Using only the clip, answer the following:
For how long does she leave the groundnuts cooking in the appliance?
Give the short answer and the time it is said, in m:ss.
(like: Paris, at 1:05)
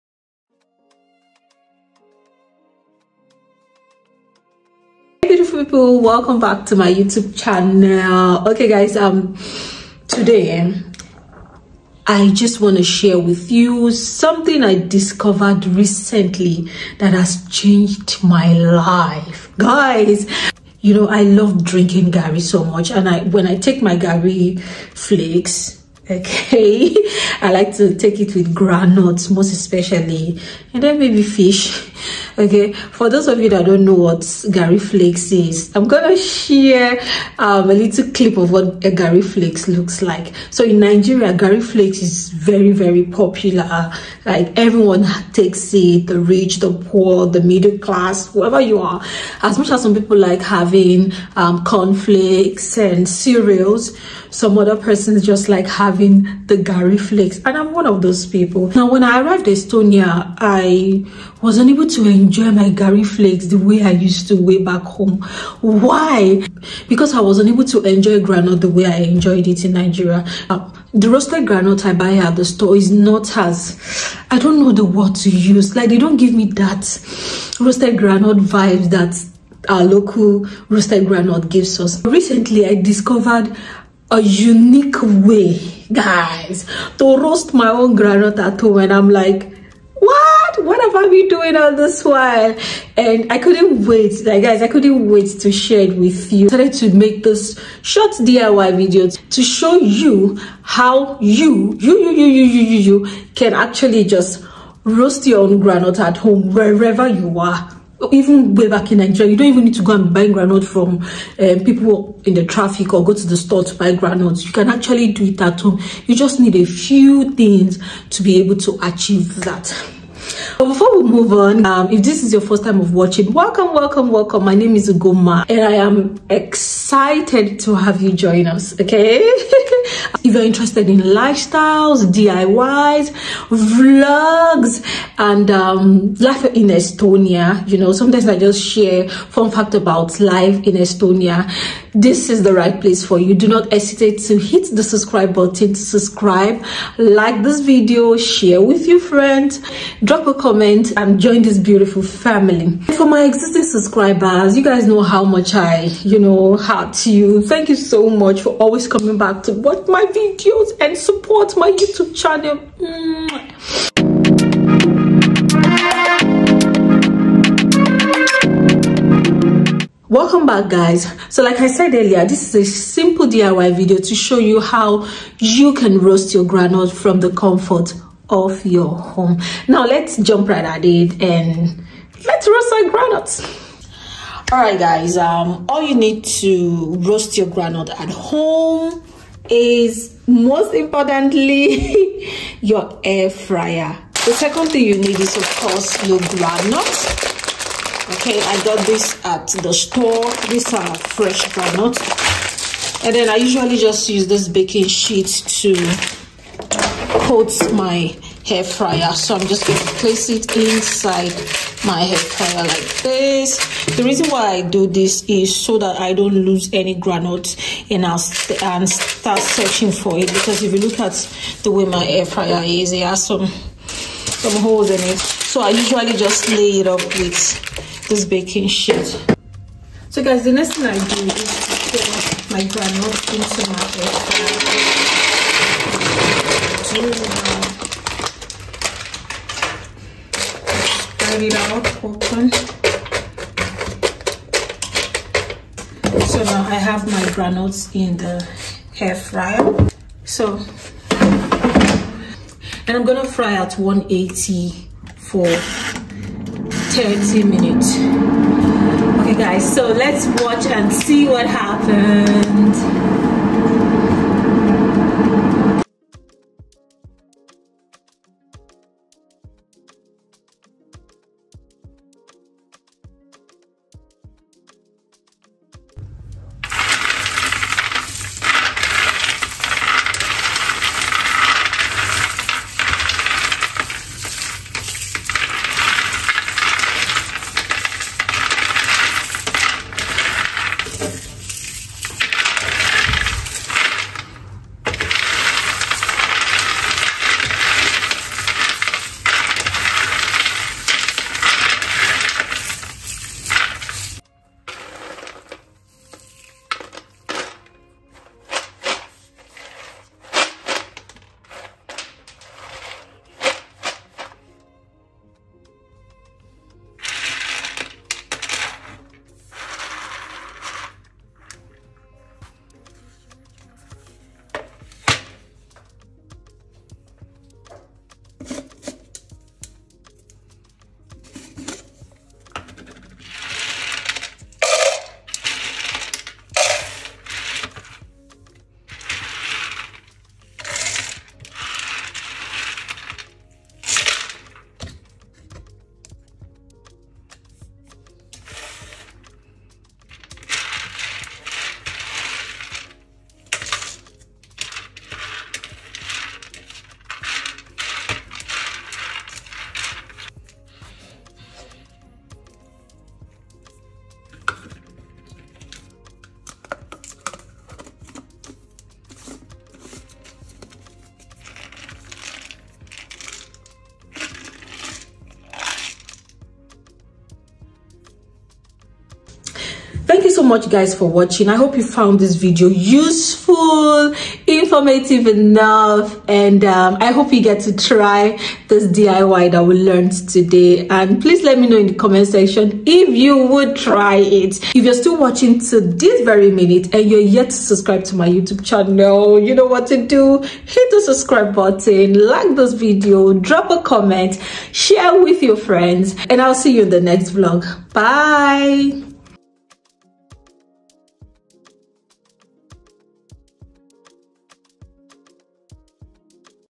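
30 minutes, at 4:16.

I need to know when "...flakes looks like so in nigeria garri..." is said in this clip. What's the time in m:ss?
0:39.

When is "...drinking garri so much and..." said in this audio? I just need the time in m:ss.
0:21.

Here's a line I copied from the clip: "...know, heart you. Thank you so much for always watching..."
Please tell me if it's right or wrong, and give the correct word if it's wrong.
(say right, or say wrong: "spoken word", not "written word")
wrong: "coming", not "watching".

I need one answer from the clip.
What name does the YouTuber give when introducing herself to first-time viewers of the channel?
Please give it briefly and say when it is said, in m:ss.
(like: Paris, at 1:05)
Ugoma, at 2:04.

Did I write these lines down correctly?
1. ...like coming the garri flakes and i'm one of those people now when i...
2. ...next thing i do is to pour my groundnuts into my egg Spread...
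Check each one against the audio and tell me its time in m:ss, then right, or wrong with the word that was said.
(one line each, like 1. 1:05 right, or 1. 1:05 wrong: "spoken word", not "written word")
1. 0:55 wrong: "having", not "coming"
2. 3:50 right.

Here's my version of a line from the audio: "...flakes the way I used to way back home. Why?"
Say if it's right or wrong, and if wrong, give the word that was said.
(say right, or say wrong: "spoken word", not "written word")
right.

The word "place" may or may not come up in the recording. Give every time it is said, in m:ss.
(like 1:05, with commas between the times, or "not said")
2:22, 3:30.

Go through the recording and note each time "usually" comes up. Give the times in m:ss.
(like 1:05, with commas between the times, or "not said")
3:23, 3:45.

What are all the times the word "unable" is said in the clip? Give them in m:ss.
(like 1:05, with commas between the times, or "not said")
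1:01, 1:07.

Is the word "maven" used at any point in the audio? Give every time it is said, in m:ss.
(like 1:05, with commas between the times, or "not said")
not said.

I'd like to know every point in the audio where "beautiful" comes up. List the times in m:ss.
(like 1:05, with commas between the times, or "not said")
0:05, 2:31.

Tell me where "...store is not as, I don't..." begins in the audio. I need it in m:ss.
1:12.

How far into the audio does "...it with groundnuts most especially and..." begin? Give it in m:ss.
0:28.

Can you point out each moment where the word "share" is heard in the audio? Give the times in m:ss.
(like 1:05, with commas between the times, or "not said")
0:12, 0:36, 1:35, 2:18, 2:28, 6:44.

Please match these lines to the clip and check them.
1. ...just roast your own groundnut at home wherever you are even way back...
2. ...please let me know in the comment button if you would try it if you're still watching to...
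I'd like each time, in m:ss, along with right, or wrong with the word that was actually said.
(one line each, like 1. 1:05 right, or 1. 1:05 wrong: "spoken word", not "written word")
1. 1:44 right
2. 6:31 wrong: "section", not "button".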